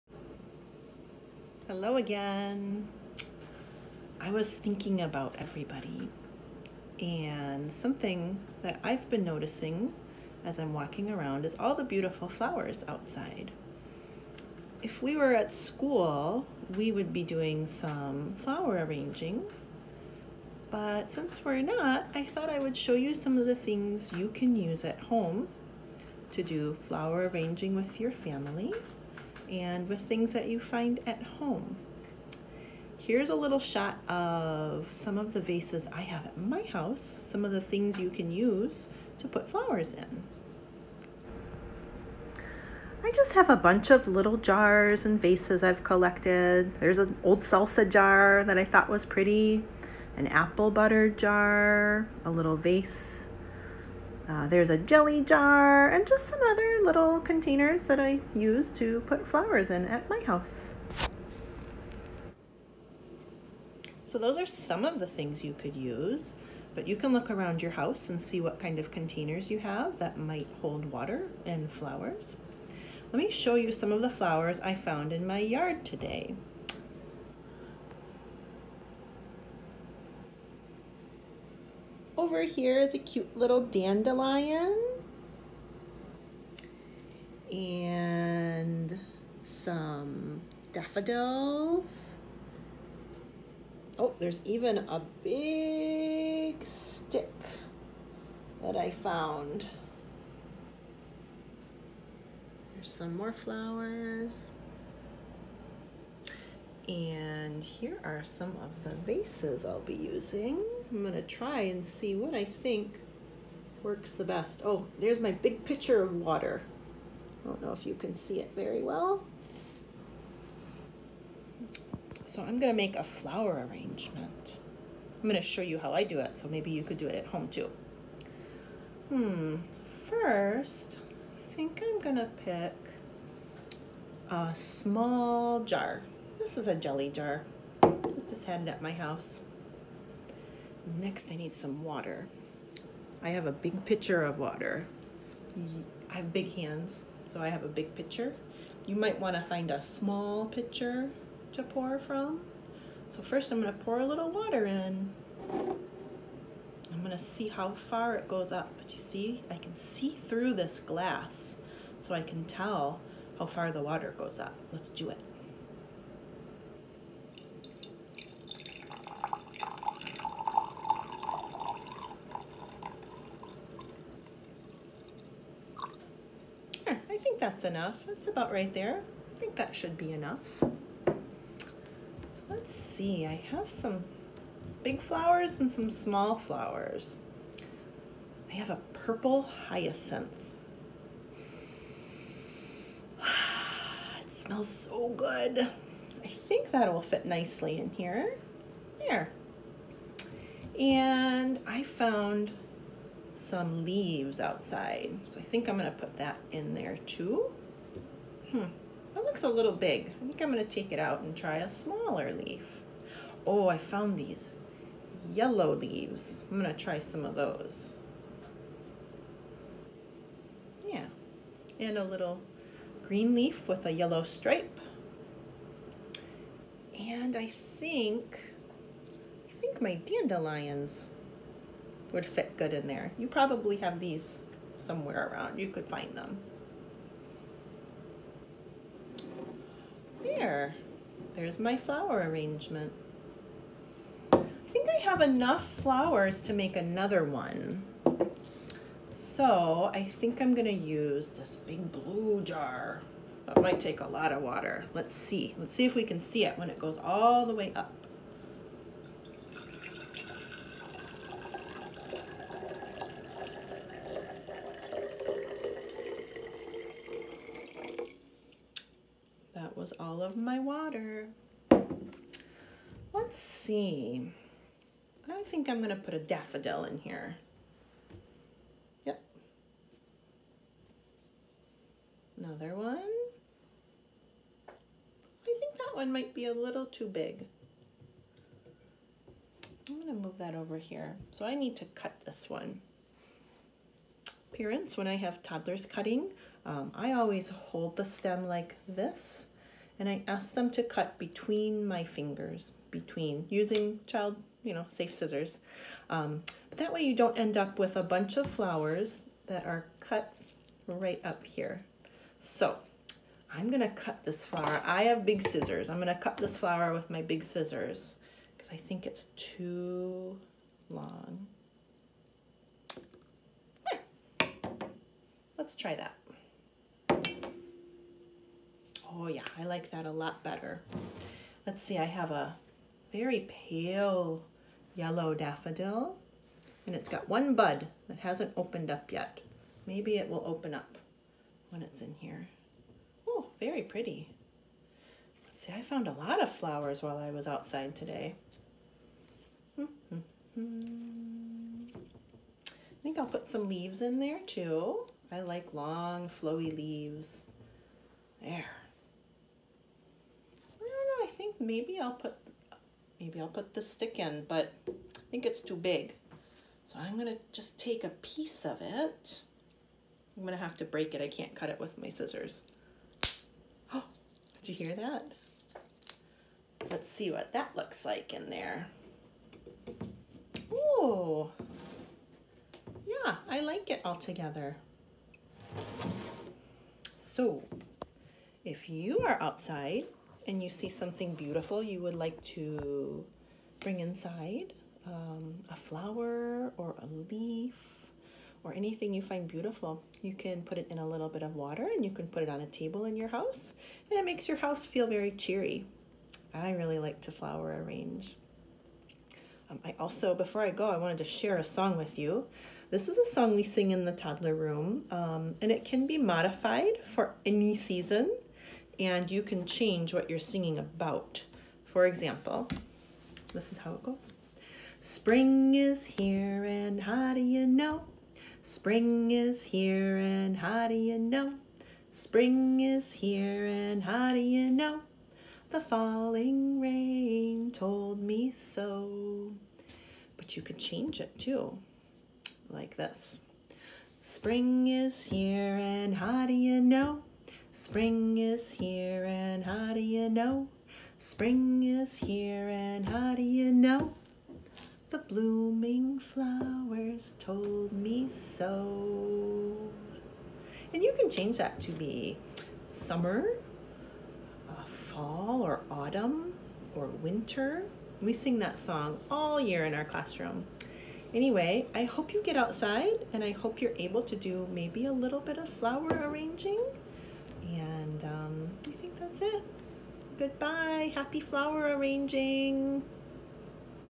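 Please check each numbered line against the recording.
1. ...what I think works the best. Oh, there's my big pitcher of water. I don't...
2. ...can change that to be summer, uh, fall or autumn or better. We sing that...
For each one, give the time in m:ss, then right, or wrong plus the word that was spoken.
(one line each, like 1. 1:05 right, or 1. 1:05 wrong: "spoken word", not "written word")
1. 1:52 right
2. 7:41 wrong: "winter", not "better".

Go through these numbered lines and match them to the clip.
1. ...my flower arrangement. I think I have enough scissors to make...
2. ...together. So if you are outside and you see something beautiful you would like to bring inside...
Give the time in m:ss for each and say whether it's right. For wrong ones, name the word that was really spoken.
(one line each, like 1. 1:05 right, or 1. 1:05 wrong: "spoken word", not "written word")
1. 4:01 wrong: "flowers", not "scissors"
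2. 6:24 right.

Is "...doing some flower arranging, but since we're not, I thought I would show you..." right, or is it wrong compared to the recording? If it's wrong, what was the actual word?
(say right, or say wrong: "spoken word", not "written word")
right.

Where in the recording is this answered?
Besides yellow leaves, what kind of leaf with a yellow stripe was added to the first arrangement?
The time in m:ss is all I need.
3:43.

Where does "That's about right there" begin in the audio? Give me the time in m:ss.
2:58.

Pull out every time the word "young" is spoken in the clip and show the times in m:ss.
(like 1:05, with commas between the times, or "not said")
not said.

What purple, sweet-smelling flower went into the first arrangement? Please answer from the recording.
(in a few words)
hyacinth.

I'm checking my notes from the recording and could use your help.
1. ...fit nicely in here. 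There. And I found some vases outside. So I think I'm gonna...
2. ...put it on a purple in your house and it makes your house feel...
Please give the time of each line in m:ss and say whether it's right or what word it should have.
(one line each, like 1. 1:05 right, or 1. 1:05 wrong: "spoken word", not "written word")
1. 3:17 wrong: "leaves", not "vases"
2. 6:42 wrong: "table", not "purple".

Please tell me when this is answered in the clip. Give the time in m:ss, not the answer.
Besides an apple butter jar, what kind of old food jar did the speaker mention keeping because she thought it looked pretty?
0:47.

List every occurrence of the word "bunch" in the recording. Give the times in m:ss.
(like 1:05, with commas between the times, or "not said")
0:43, 5:08.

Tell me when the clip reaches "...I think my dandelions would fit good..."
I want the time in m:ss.
3:49.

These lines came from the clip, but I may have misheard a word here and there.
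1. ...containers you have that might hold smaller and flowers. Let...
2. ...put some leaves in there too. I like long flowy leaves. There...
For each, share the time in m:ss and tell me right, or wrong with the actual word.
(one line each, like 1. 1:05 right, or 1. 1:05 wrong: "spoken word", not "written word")
1. 1:08 wrong: "water", not "smaller"
2. 5:53 right.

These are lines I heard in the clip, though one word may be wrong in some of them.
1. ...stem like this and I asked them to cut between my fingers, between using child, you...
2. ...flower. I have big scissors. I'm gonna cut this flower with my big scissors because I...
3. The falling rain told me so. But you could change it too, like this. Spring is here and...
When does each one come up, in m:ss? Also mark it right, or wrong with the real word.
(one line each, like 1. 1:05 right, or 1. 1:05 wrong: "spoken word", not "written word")
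1. 4:58 right
2. 5:14 right
3. 7:15 right.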